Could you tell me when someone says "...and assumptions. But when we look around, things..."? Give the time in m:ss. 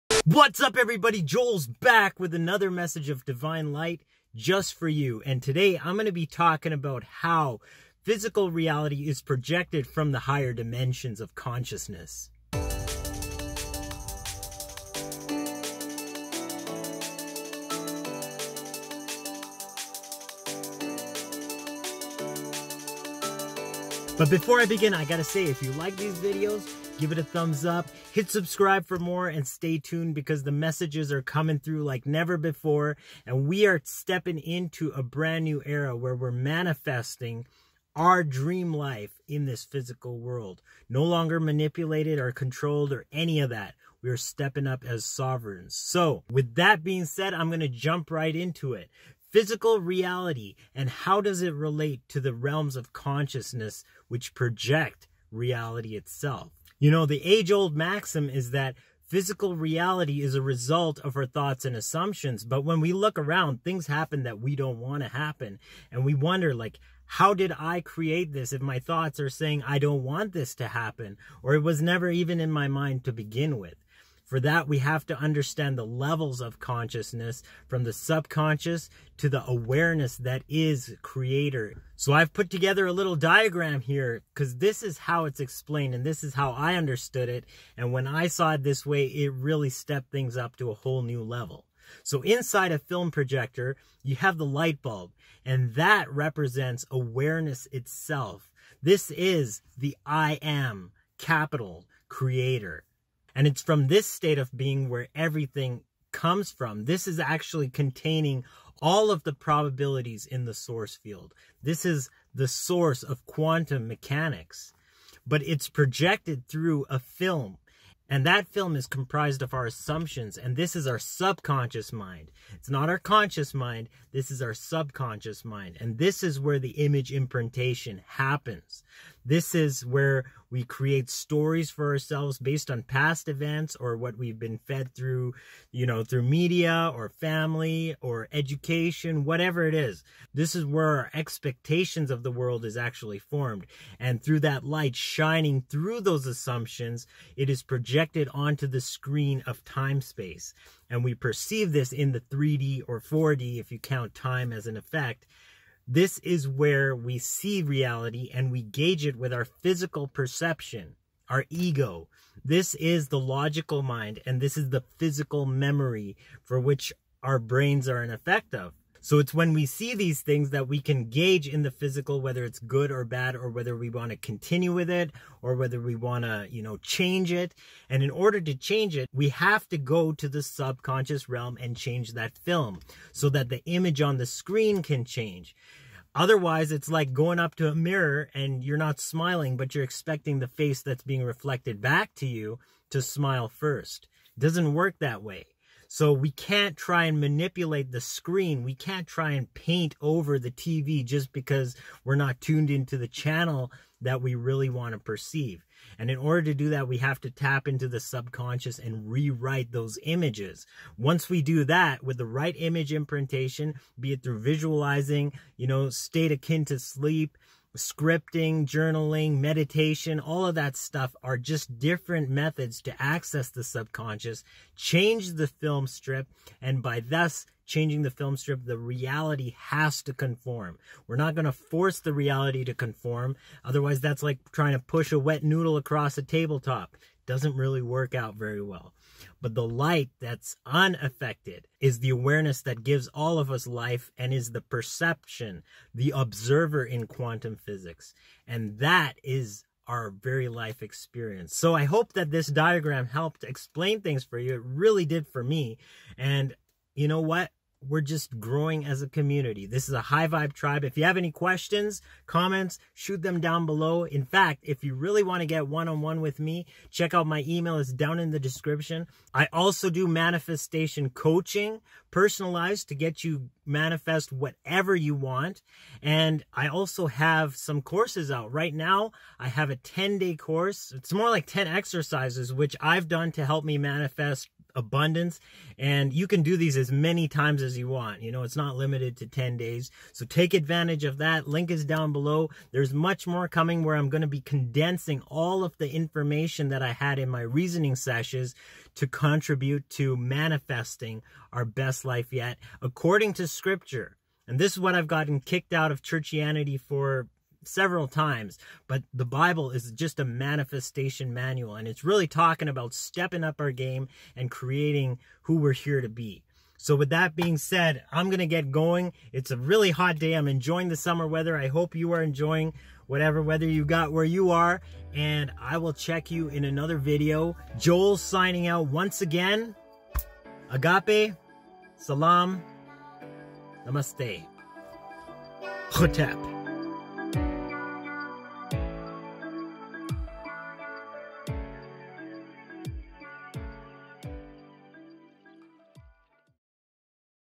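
1:01.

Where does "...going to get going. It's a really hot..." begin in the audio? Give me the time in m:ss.
5:18.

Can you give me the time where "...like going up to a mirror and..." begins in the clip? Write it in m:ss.
3:06.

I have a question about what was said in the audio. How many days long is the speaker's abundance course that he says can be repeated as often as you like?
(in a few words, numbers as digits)
10.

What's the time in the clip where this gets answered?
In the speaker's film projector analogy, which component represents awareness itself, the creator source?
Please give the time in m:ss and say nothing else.
1:34.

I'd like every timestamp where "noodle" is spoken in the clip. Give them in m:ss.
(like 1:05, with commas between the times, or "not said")
3:55.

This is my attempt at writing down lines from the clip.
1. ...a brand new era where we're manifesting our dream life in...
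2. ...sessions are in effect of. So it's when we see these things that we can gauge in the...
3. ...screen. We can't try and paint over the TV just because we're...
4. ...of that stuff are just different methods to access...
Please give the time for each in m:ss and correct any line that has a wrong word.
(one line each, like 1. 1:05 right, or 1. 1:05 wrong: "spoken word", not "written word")
1. 0:34 right
2. 2:47 wrong: "brains", not "sessions"
3. 3:17 right
4. 3:40 right.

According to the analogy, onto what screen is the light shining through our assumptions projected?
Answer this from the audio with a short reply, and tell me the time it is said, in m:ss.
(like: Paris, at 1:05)
Time space, at 2:29.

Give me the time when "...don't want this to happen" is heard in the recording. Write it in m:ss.
1:09.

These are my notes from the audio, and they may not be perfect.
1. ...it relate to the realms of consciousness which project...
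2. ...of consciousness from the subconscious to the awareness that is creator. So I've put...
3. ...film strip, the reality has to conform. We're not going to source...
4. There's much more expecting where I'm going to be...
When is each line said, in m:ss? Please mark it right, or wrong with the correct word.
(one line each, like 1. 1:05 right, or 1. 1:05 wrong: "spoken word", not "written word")
1. 0:51 right
2. 1:16 right
3. 3:48 wrong: "force", not "source"
4. 4:52 wrong: "coming", not "expecting".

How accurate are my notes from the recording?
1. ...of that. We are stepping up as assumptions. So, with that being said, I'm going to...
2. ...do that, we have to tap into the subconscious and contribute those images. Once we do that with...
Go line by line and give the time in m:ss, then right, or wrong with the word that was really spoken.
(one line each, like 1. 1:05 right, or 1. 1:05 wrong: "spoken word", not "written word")
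1. 0:43 wrong: "sovereigns", not "assumptions"
2. 3:26 wrong: "rewrite", not "contribute".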